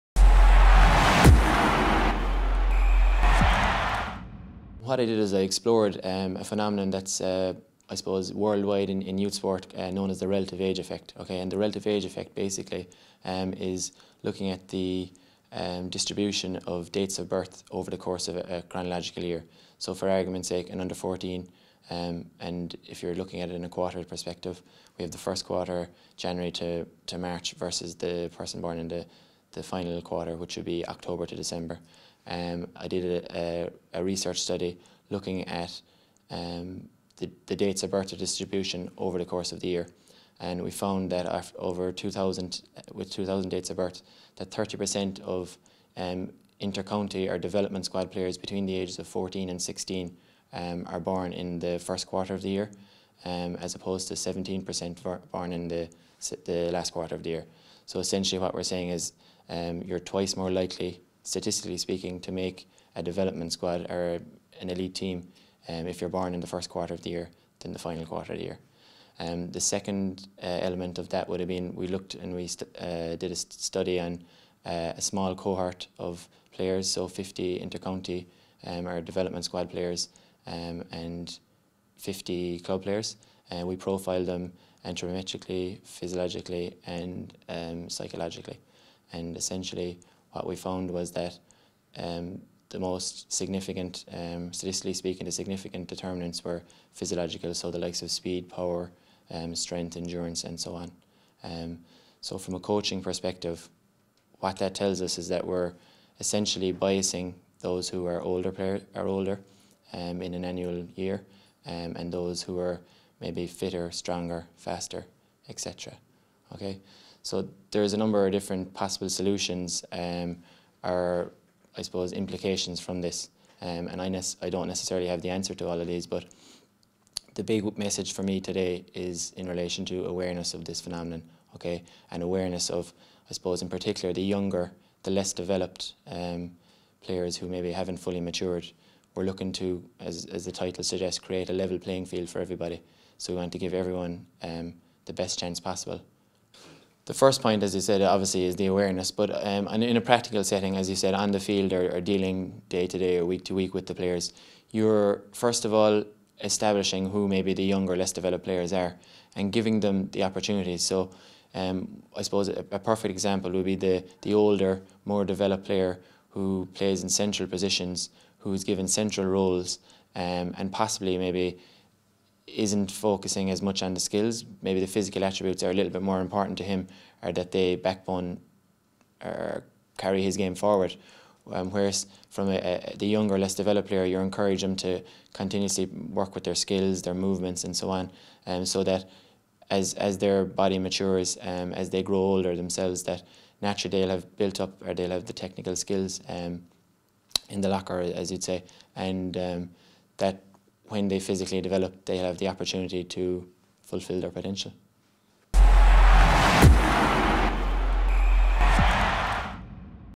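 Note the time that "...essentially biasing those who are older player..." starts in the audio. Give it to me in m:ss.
1:46.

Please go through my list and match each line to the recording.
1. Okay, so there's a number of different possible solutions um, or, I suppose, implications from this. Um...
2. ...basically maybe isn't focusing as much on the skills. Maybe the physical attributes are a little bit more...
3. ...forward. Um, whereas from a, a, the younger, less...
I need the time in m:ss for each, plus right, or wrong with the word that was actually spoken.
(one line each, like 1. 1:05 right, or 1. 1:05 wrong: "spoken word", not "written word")
1. 1:56 right
2. 2:50 wrong: "possibly", not "basically"
3. 3:00 right.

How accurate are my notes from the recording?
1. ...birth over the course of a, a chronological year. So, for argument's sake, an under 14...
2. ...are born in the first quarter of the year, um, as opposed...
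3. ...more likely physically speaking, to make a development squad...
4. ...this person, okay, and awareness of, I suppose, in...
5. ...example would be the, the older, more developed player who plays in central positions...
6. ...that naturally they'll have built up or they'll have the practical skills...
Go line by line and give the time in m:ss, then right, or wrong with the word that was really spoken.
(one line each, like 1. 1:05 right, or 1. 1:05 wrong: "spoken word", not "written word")
1. 0:17 right
2. 0:50 right
3. 1:00 wrong: "statistically", not "physically"
4. 2:10 wrong: "phenomenon", not "person"
5. 2:43 right
6. 3:13 wrong: "technical", not "practical".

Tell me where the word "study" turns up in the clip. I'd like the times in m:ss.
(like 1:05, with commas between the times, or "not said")
0:34, 1:13.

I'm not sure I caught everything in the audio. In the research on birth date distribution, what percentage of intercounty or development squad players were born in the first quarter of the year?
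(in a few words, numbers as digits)
30%.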